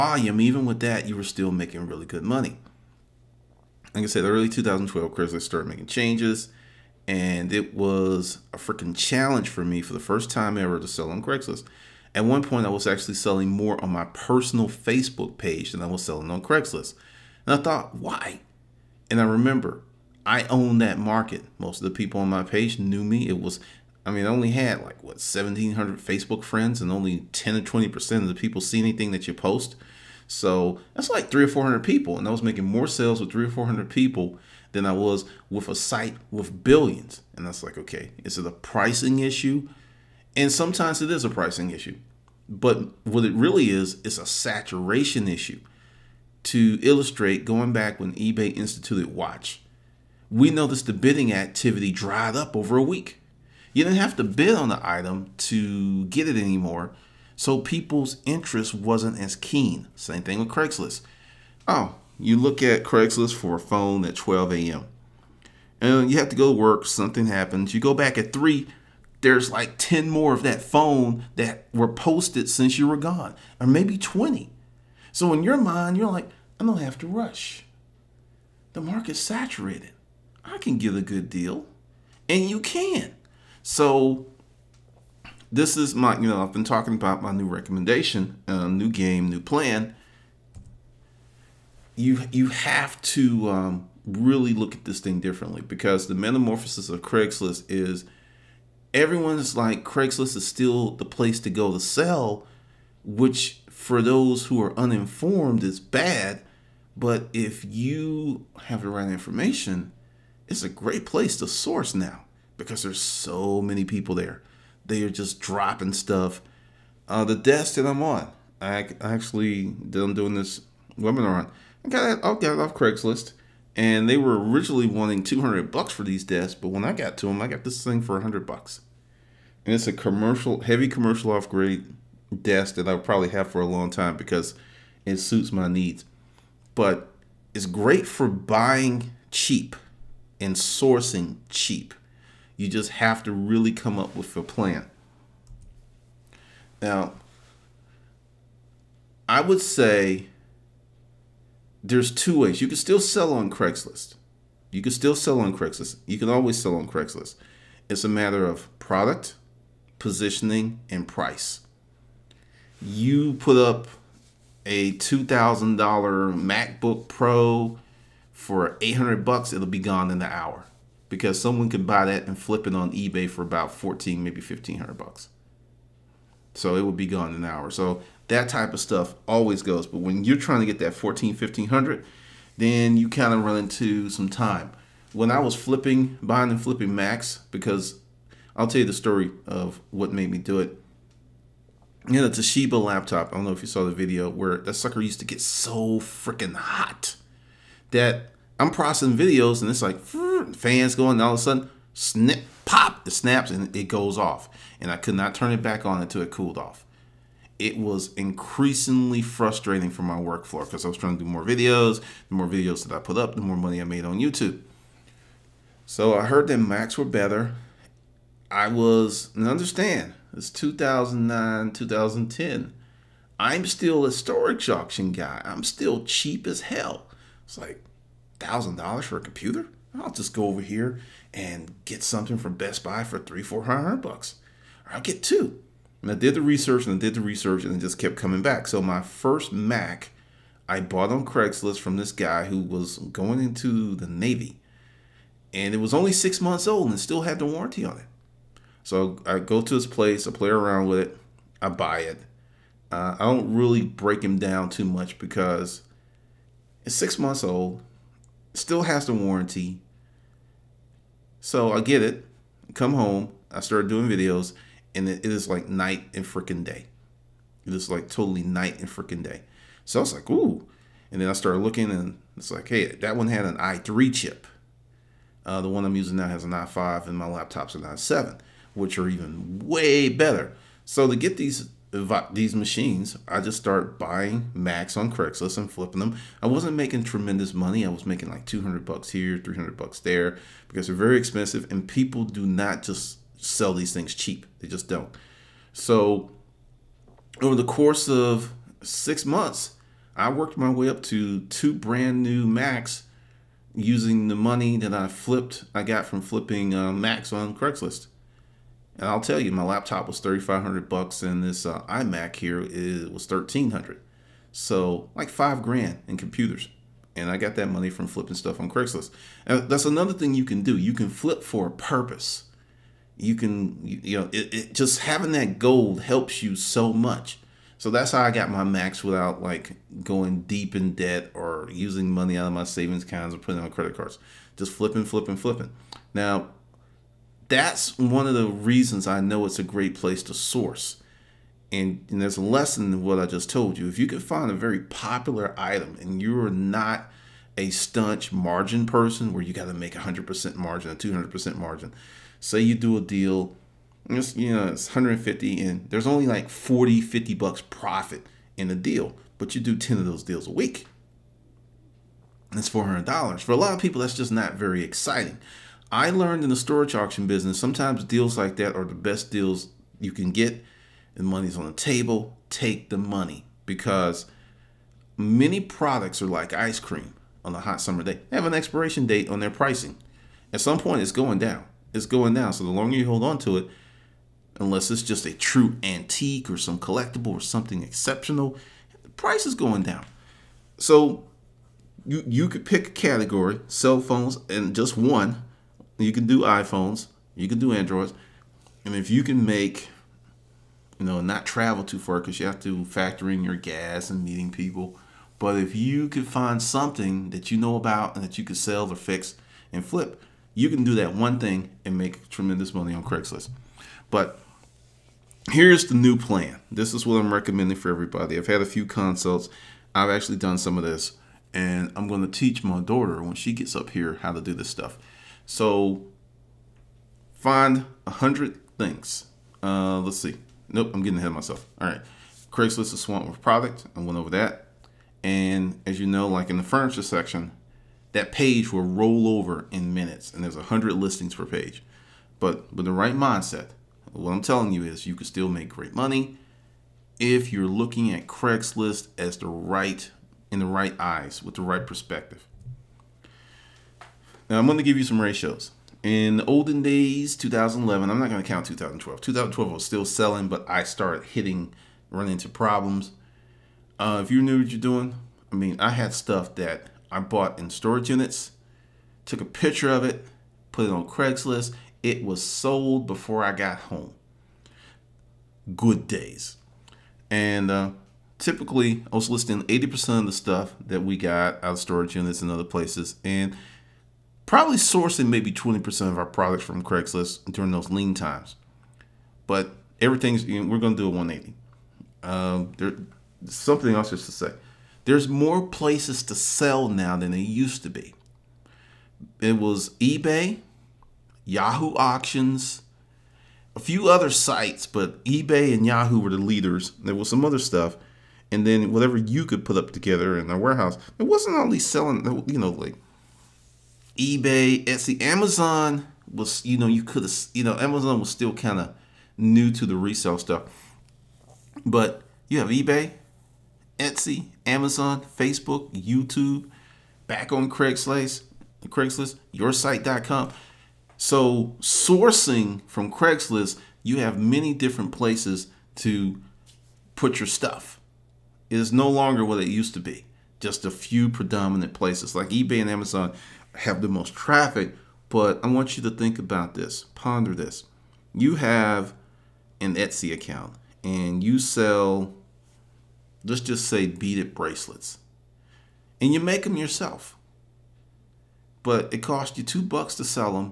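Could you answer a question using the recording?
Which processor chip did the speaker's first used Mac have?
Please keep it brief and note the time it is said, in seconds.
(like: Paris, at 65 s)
i3, at 273 s.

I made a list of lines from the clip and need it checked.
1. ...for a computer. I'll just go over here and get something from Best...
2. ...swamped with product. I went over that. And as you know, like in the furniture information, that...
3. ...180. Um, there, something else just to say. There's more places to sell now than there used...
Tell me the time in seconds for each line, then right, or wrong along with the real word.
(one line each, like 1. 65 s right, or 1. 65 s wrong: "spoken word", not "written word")
1. 229 s right
2. 432 s wrong: "section", not "information"
3. 491 s right.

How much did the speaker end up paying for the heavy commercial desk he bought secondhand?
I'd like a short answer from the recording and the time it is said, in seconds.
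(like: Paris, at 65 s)
$100, at 128 s.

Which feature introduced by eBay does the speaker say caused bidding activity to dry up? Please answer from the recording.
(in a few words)
watch.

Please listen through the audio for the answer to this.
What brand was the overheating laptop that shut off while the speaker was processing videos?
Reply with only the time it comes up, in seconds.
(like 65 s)
192 s.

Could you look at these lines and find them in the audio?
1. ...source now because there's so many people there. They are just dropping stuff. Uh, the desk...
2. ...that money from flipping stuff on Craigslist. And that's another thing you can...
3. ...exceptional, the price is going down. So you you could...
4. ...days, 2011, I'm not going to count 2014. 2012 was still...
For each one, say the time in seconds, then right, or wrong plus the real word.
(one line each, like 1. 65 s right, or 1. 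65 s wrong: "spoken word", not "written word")
1. 111 s right
2. 317 s right
3. 387 s right
4. 456 s wrong: "2012", not "2014".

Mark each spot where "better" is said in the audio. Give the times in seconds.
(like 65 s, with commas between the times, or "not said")
217 s, 280 s.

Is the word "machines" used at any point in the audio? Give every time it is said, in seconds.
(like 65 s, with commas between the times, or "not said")
282 s.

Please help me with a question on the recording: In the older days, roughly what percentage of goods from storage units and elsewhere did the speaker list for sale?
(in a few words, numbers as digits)
80%.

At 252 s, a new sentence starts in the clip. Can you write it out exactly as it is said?
Uh, I don't really break him down too much because it's six months old, still has the warranty.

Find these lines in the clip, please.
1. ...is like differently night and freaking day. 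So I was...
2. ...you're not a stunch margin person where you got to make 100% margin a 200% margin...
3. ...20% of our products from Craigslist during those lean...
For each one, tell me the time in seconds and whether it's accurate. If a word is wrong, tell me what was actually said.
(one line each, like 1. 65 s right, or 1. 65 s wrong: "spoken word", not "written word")
1. 267 s wrong: "totally", not "differently"
2. 346 s right
3. 485 s right.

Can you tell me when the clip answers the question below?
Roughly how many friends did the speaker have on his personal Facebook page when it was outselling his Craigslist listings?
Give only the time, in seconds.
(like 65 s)
25 s.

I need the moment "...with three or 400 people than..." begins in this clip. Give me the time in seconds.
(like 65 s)
33 s.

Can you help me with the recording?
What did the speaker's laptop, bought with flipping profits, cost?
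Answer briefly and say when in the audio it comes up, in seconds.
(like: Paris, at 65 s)
$3,500, at 310 s.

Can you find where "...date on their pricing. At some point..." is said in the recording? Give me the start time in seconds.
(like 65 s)
379 s.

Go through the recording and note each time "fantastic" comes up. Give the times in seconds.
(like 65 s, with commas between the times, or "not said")
not said.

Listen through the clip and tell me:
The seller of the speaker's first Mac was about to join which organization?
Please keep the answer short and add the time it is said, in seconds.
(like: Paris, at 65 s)
the Navy, at 244 s.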